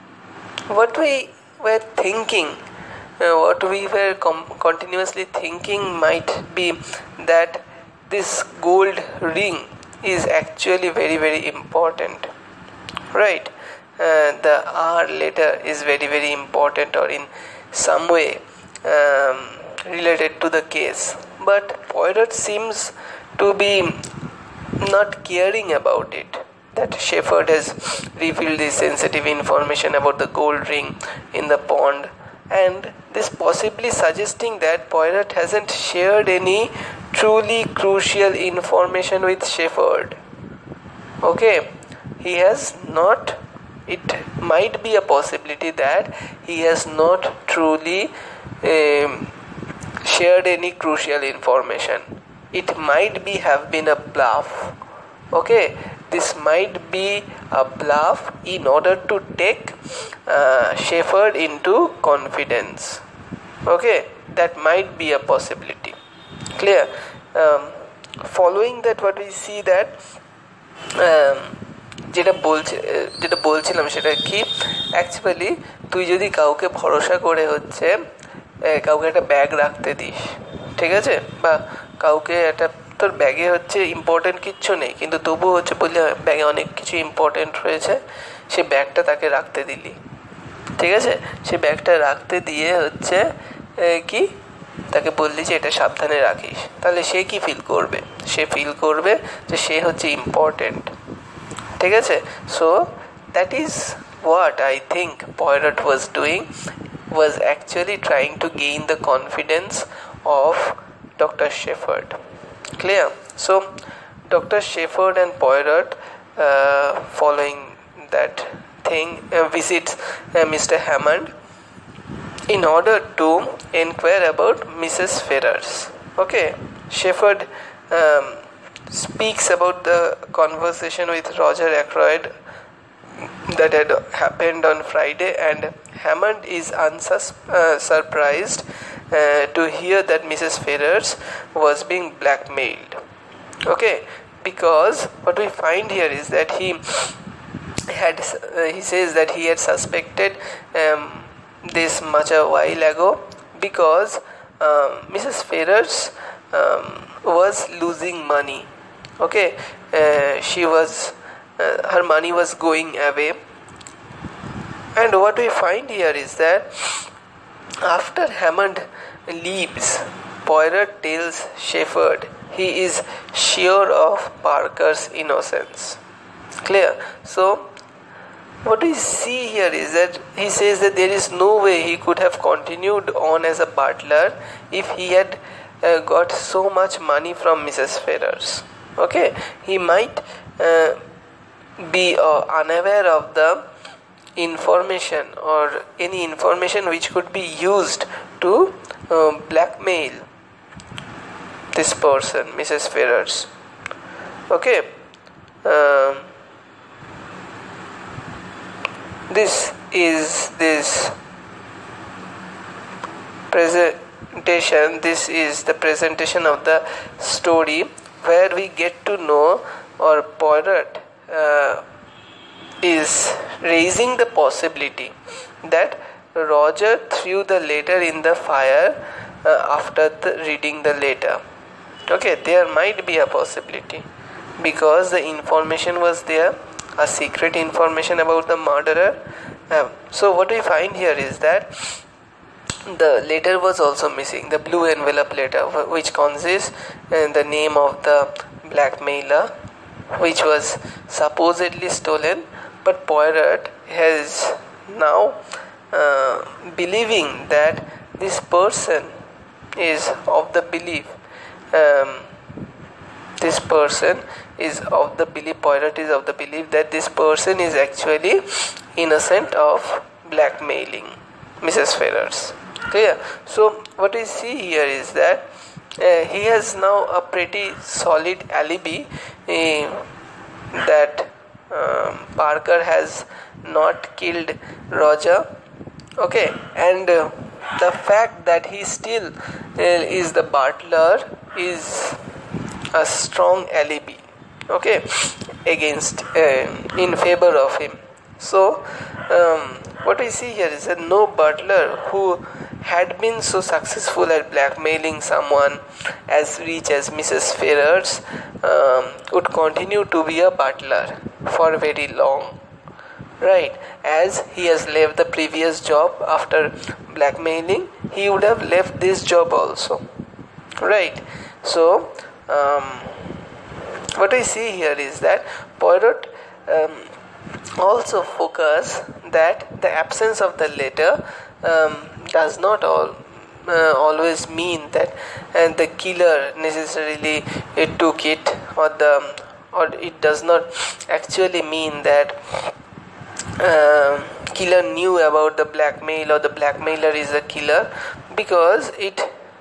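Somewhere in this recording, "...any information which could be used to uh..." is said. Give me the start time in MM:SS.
03:15.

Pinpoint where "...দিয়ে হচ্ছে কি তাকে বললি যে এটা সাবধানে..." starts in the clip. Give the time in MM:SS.
01:32.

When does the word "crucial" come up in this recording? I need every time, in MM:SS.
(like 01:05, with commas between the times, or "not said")
00:37, 00:50.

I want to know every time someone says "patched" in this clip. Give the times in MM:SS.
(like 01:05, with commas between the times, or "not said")
not said.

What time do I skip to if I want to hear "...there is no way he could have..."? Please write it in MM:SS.
03:00.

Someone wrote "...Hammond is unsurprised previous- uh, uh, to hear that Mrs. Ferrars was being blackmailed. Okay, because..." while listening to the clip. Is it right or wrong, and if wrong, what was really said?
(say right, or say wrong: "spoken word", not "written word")
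wrong: "unsus", not "previous".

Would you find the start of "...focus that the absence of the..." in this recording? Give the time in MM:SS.
05:28.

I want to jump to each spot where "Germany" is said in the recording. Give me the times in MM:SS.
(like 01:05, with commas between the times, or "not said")
not said.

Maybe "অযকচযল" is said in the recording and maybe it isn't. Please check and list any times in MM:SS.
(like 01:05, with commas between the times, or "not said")
01:14, 01:47.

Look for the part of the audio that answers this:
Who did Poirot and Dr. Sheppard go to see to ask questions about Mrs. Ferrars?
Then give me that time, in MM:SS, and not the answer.
02:00.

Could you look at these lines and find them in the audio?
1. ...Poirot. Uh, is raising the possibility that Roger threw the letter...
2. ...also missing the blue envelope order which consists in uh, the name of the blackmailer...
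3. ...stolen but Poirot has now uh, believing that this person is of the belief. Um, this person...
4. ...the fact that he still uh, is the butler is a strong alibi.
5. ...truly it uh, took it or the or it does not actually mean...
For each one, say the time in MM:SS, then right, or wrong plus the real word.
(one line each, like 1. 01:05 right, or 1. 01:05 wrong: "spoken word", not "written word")
1. 03:40 right
2. 04:03 wrong: "letter", not "order"
3. 04:11 right
4. 04:47 right
5. 05:36 wrong: "necessarily", not "truly".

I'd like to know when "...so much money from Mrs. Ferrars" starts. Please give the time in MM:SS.
03:06.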